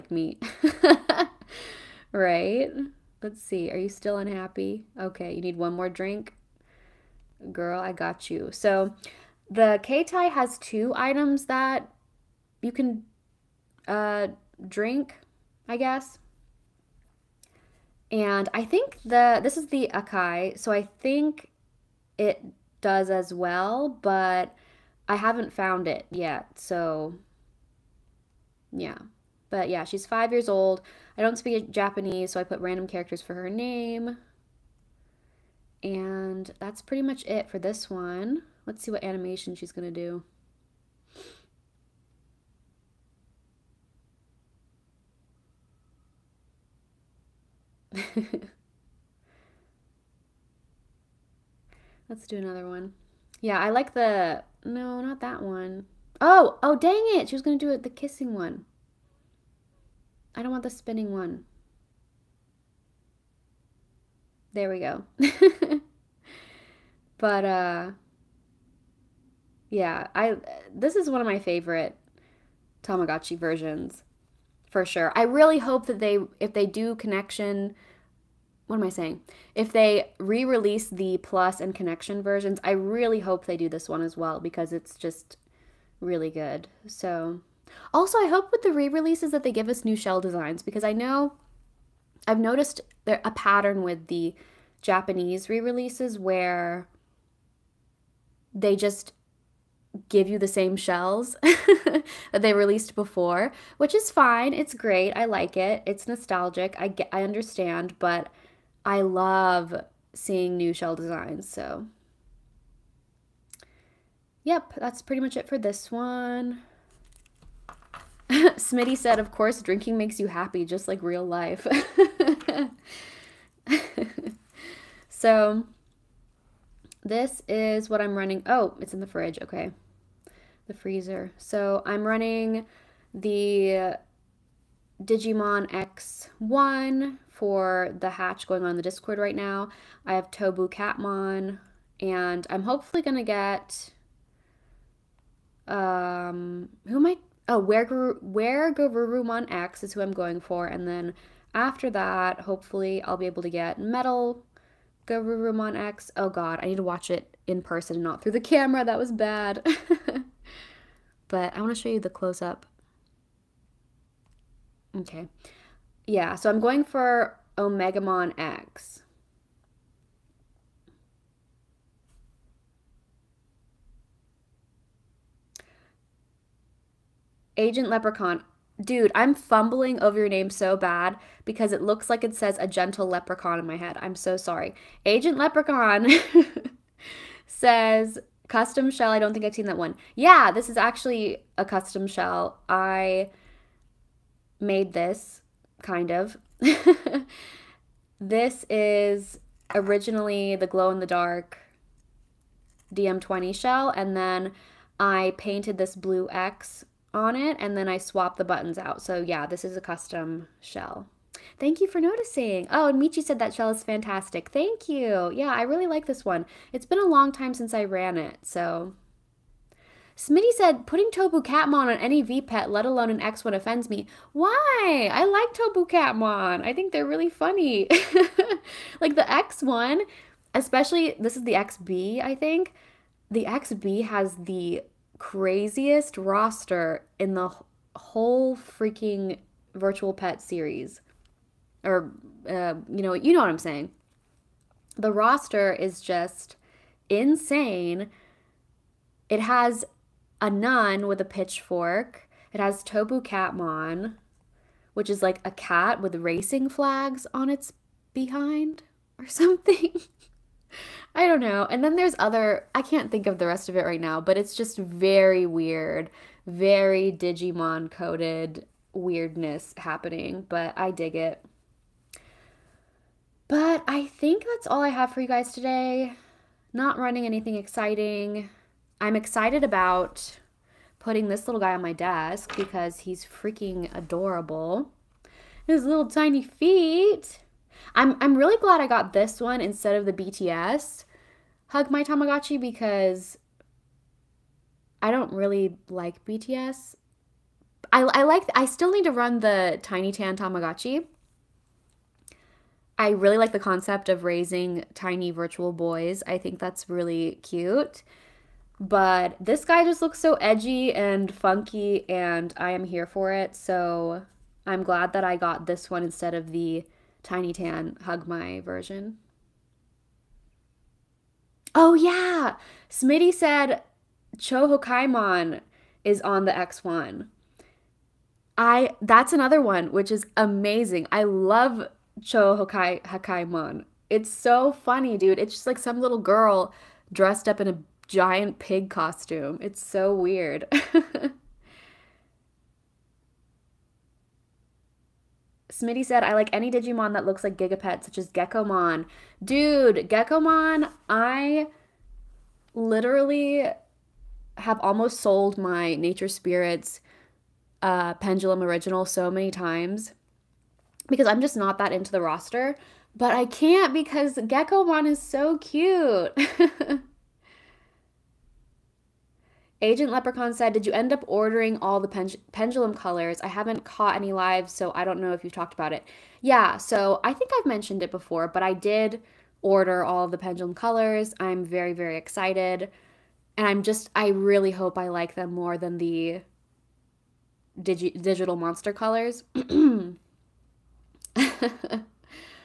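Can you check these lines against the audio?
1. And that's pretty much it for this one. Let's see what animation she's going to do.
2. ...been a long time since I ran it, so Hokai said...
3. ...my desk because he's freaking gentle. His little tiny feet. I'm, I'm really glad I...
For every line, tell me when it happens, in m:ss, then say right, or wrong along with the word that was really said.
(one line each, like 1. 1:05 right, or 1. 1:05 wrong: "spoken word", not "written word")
1. 0:35 right
2. 3:36 wrong: "Smitty", not "Hokai"
3. 4:41 wrong: "adorable", not "gentle".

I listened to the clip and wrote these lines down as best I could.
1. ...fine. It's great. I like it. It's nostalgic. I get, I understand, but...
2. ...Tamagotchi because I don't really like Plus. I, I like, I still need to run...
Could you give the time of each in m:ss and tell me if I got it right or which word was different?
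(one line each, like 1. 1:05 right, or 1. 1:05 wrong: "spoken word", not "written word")
1. 1:44 right
2. 4:52 wrong: "BTS", not "Plus".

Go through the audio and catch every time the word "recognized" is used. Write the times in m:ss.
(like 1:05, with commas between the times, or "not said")
not said.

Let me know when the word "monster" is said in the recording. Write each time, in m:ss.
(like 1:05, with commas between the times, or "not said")
6:28.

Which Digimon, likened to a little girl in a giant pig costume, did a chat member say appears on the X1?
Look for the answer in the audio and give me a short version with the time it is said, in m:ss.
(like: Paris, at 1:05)
Cho Hakkaimon, at 5:24.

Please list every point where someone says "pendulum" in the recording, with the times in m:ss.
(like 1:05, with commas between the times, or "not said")
5:58, 6:12, 6:20.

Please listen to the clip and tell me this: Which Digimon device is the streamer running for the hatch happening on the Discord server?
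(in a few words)
Digimon X1.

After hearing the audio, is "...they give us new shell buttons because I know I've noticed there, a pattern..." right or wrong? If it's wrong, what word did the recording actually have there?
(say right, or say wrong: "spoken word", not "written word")
wrong: "designs", not "buttons".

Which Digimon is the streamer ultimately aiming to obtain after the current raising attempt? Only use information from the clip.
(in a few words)
Omegamon X.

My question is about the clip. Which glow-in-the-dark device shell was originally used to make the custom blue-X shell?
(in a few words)
DM20.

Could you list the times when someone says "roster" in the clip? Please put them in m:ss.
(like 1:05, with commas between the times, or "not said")
3:56, 4:05, 6:02.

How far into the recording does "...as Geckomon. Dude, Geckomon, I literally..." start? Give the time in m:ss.
5:48.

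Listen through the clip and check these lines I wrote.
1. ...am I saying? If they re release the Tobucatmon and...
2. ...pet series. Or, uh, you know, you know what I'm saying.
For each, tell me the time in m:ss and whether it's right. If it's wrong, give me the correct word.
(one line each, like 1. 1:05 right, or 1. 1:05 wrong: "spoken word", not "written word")
1. 1:18 wrong: "Plus", not "Tobucatmon"
2. 4:00 right.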